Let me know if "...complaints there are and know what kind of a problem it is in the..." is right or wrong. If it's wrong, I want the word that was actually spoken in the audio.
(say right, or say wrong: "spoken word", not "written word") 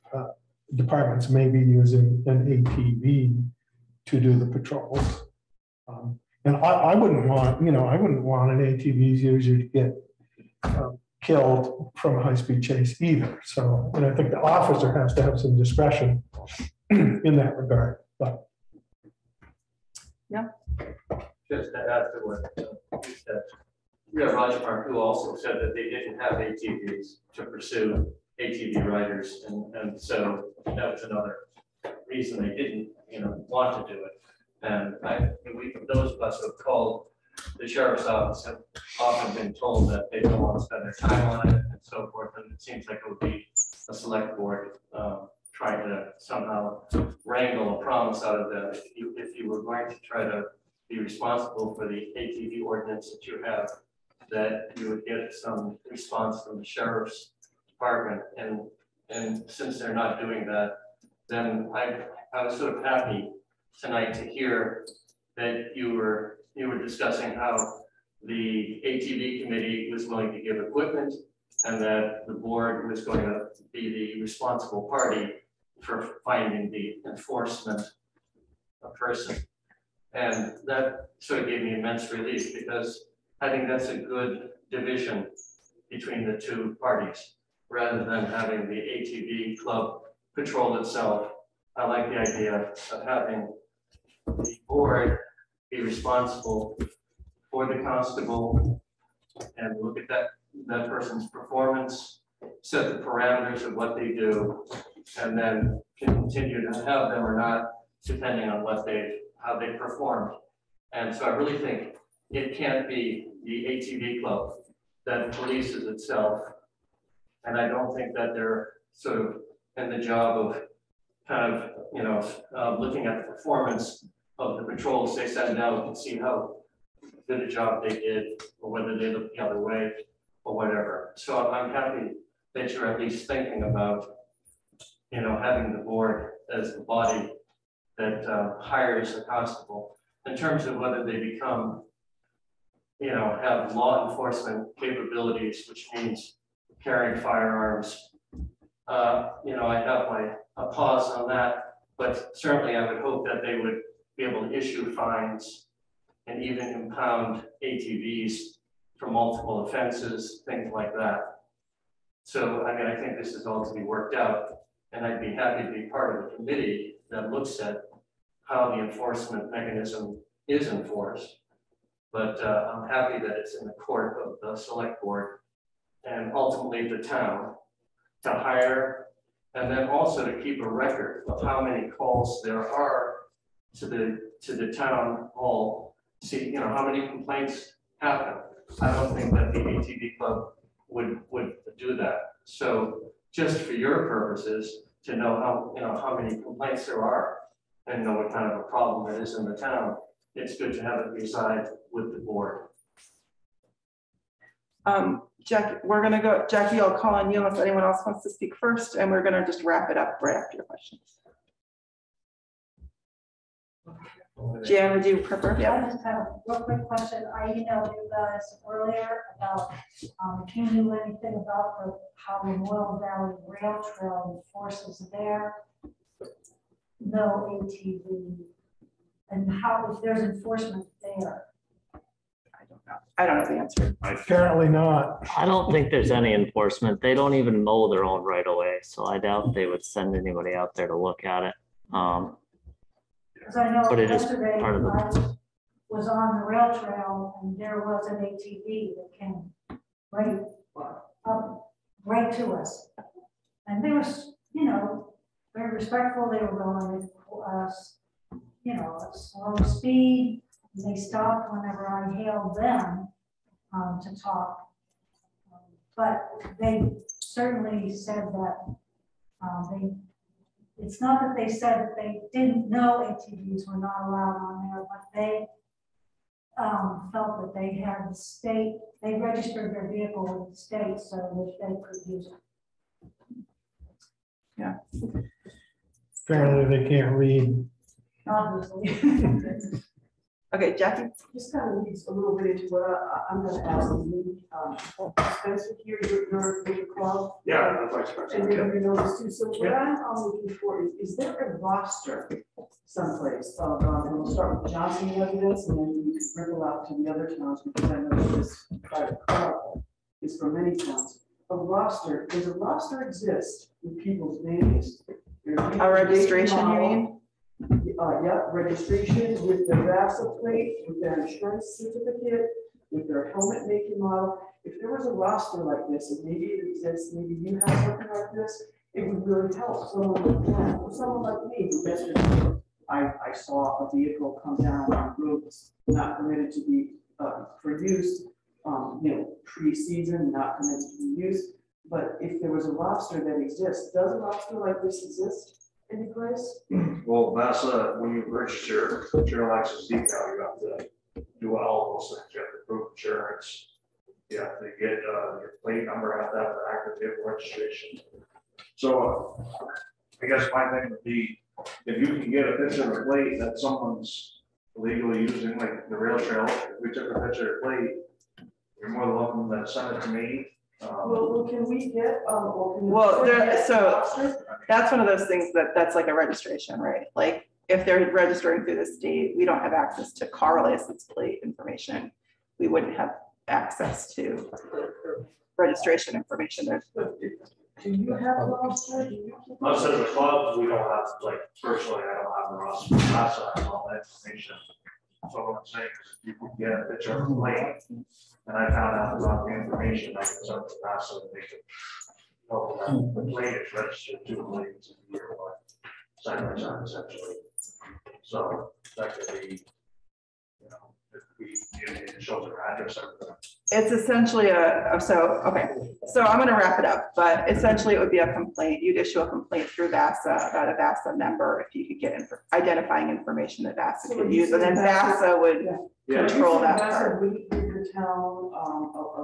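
right.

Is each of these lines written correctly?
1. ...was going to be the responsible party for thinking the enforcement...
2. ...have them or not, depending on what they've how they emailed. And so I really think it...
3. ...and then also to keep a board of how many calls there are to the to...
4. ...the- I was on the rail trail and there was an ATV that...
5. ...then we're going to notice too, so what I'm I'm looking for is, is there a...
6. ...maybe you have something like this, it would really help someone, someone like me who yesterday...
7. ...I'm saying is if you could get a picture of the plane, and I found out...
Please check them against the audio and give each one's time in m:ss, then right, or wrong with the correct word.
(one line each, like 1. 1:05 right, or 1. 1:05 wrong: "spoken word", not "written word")
1. 1:12 wrong: "finding", not "thinking"
2. 1:46 wrong: "performed", not "emailed"
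3. 2:59 wrong: "record", not "board"
4. 4:04 right
5. 4:58 right
6. 5:27 right
7. 6:35 right.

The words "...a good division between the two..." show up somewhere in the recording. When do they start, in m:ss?
1:23.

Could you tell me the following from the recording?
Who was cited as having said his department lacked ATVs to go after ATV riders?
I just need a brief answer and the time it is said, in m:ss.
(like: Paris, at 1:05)
Roger Park, at 0:24.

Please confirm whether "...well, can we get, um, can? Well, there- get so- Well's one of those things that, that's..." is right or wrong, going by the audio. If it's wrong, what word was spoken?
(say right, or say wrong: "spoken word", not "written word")
wrong: "That", not "Well".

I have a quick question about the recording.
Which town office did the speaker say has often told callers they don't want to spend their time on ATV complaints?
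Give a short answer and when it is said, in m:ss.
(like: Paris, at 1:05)
sheriff's office, at 0:37.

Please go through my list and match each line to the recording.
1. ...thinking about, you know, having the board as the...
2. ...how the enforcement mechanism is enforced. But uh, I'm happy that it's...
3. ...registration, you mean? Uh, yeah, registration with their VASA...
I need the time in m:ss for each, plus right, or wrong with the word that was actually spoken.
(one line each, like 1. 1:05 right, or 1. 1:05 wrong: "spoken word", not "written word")
1. 2:13 right
2. 2:48 right
3. 5:15 right.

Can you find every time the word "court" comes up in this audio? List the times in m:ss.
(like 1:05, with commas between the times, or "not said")
2:53.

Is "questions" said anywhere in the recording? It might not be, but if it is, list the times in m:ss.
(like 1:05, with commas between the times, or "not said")
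3:30, 3:36.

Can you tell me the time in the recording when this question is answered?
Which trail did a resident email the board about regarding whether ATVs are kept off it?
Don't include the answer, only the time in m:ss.
3:42.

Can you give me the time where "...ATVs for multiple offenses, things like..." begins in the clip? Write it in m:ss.
2:37.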